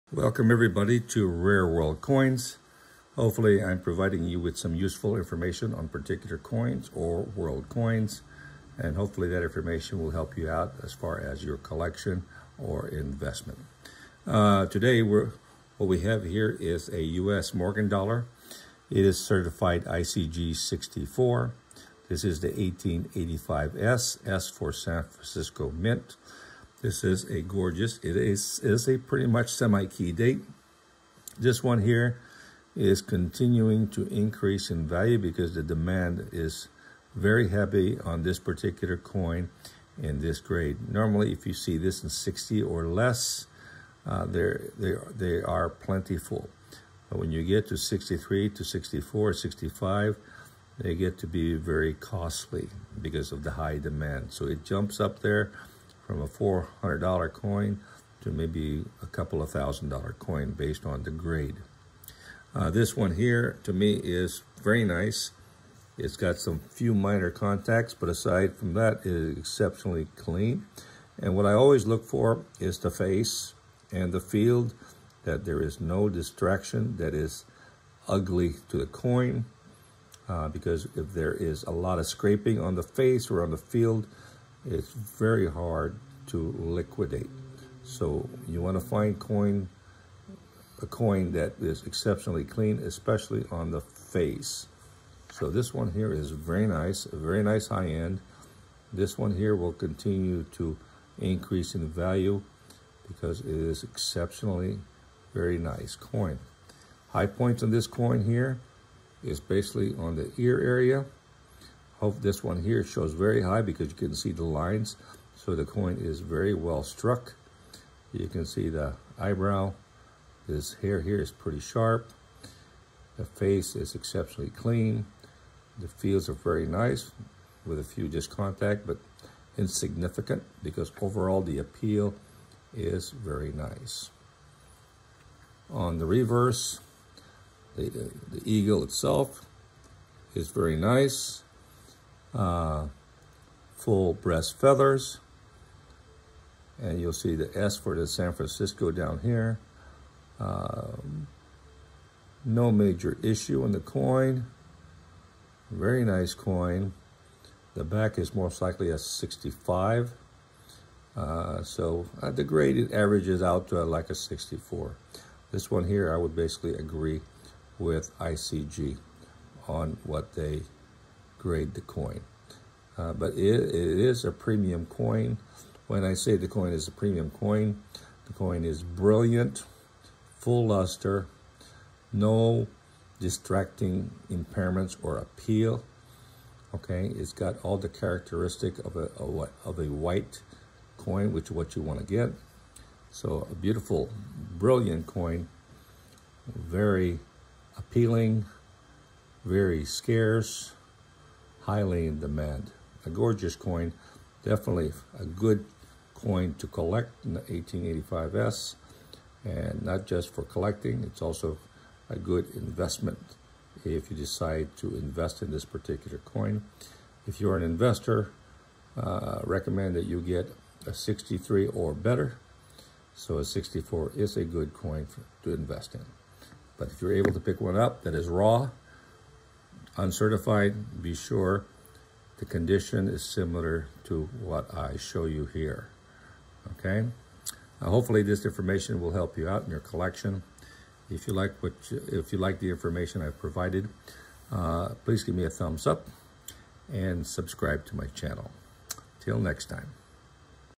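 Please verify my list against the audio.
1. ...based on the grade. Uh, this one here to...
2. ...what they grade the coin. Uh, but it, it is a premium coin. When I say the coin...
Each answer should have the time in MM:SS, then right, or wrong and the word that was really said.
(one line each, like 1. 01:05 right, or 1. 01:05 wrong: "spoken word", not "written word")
1. 01:00 right
2. 02:50 right.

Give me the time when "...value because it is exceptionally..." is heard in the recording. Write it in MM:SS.
01:41.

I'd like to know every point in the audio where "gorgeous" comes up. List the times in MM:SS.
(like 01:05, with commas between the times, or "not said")
00:27, 03:23.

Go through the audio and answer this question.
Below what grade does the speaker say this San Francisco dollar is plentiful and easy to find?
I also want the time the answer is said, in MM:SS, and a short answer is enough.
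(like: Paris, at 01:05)
60, at 00:42.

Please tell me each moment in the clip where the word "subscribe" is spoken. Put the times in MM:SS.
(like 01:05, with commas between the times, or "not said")
04:07.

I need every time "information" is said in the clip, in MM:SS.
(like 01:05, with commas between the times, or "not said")
00:05, 00:09, 03:58, 04:02.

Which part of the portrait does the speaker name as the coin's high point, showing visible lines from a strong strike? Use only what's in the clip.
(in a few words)
the ear area.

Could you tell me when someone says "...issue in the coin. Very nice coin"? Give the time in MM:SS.
02:33.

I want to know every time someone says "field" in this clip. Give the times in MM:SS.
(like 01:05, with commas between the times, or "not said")
01:14, 01:23, 02:05.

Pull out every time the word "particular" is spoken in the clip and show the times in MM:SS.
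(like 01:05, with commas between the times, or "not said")
00:05, 00:38, 03:35.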